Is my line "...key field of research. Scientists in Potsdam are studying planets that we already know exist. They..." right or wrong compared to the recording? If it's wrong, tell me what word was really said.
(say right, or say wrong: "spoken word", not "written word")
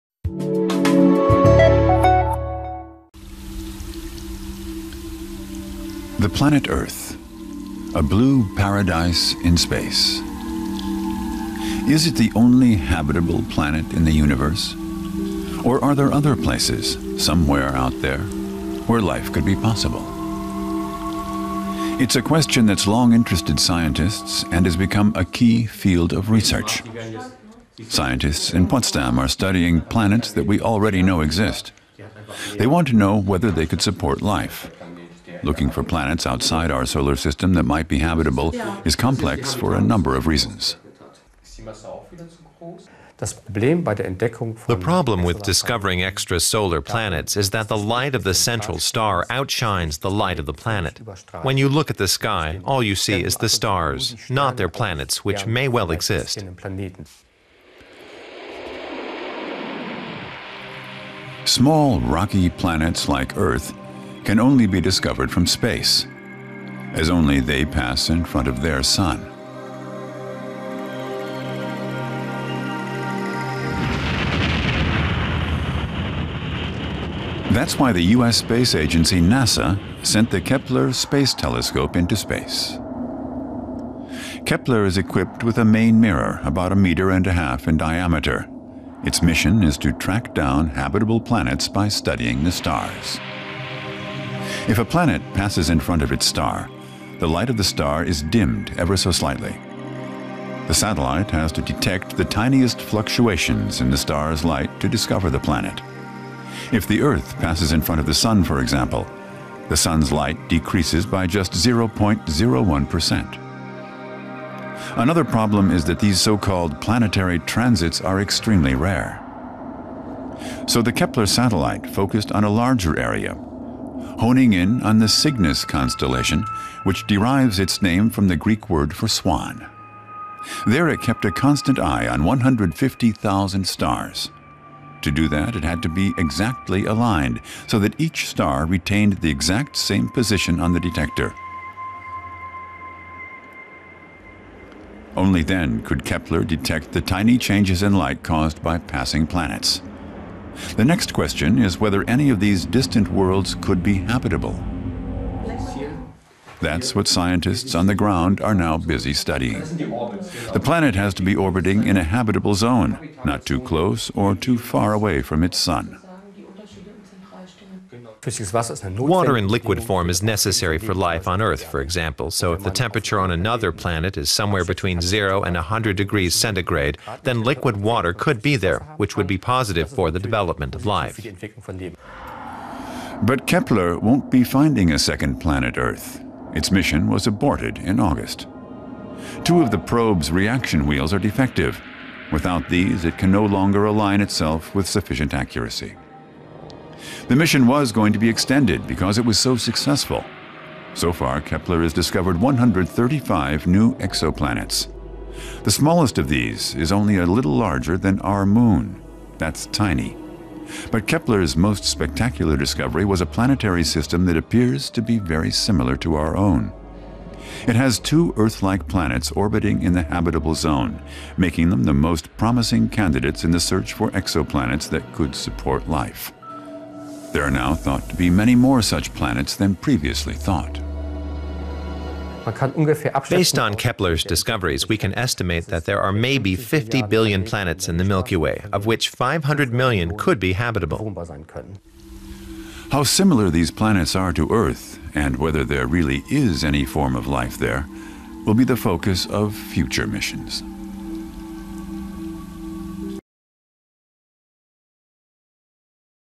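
right.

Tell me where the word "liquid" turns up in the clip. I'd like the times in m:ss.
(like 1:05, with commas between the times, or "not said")
2:49, 2:57.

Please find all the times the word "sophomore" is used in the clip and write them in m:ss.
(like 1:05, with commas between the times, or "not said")
not said.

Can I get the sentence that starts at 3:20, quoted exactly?
So far, Kepler has discovered 135 new exoplanets.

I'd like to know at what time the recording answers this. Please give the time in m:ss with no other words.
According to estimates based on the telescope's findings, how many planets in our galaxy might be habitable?
3:59.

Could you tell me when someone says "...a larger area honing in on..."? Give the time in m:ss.
2:02.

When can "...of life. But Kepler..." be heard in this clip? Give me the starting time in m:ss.
3:00.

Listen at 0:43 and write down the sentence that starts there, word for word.
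The problem with discovering extrasolar planets is that the light of the central star outshines the light of the planet.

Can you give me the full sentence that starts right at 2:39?
The planet has to be orbiting in a habitable zone, not too close or too far away from its sun.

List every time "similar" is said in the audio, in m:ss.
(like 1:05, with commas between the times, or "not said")
3:35, 4:03.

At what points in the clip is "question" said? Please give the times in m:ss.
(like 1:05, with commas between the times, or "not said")
0:22, 2:31.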